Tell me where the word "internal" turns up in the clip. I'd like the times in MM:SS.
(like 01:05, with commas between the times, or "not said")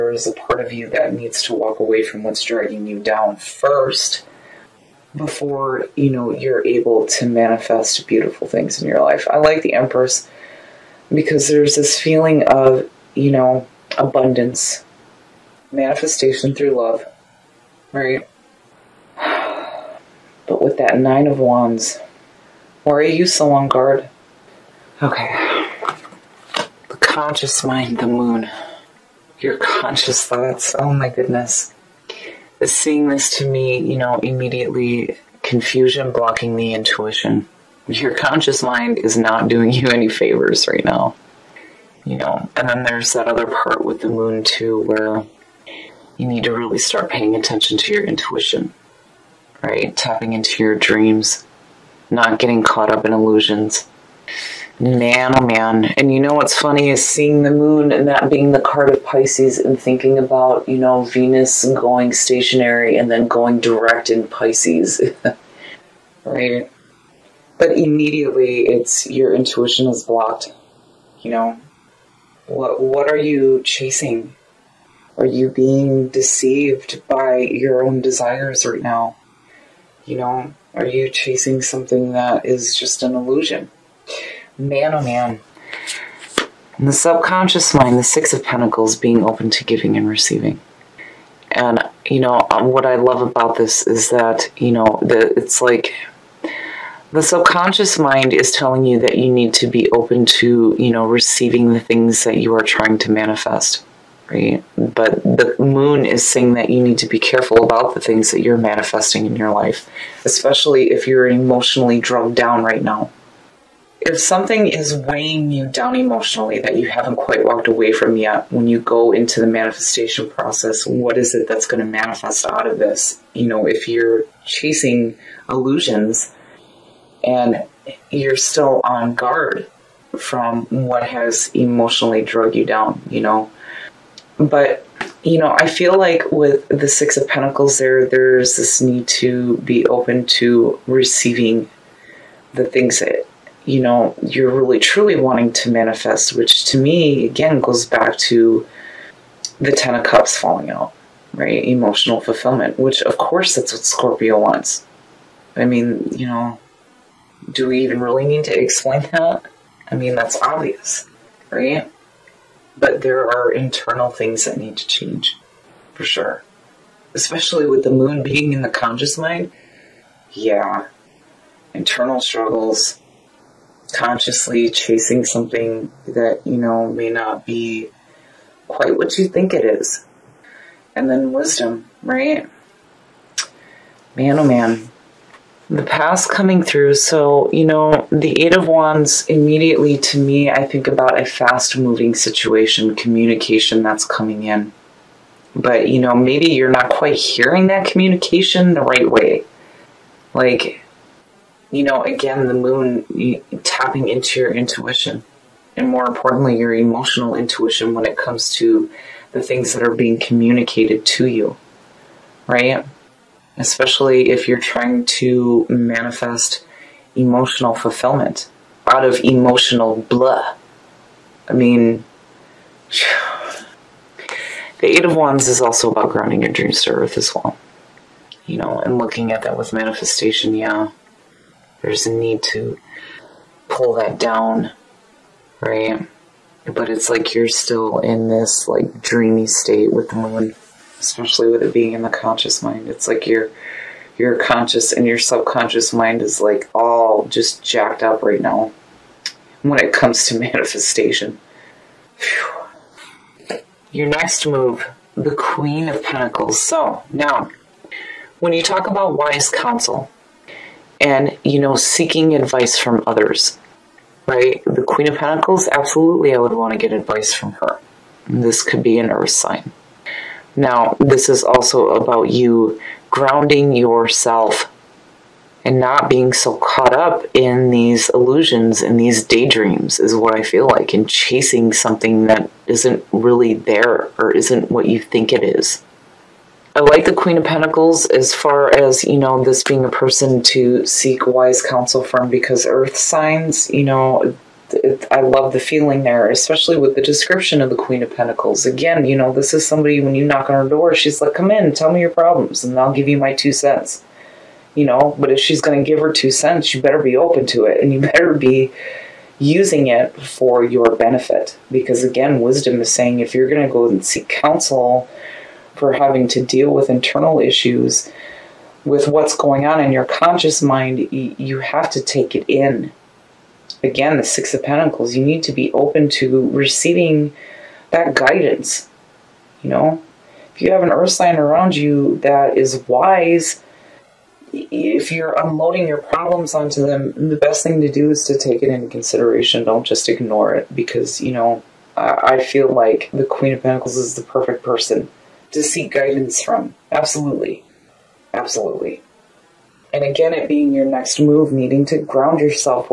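02:43, 02:51, 05:16.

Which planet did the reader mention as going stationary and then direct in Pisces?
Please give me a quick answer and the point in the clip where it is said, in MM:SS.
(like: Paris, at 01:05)
Venus, at 01:01.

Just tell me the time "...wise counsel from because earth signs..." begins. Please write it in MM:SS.
04:51.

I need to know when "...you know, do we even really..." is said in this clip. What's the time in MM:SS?
02:36.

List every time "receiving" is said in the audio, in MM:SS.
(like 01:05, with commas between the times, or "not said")
01:30, 01:41, 02:20, 05:26.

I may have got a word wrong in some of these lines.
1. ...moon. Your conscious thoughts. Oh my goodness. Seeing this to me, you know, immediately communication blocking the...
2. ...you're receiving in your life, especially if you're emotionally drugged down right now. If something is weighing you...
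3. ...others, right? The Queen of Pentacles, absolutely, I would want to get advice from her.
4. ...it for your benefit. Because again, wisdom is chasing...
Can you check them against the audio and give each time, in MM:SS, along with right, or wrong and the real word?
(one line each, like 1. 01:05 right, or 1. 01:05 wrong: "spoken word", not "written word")
1. 00:28 wrong: "confusion", not "communication"
2. 01:48 wrong: "manifesting", not "receiving"
3. 04:23 right
4. 05:09 wrong: "saying", not "chasing".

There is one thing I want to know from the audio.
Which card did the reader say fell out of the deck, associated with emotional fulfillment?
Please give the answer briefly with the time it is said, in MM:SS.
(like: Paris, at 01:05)
10 of Cups, at 02:29.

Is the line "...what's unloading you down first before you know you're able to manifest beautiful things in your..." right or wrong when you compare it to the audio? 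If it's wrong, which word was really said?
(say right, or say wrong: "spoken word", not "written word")
wrong: "dragging", not "unloading".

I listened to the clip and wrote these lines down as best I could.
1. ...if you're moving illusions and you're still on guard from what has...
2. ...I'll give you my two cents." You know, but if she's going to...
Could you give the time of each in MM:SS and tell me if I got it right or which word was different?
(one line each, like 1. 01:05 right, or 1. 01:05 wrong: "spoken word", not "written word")
1. 02:03 wrong: "chasing", not "moving"
2. 05:02 right.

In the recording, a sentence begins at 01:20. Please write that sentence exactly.
You know, are you chasing something that is just an illusion?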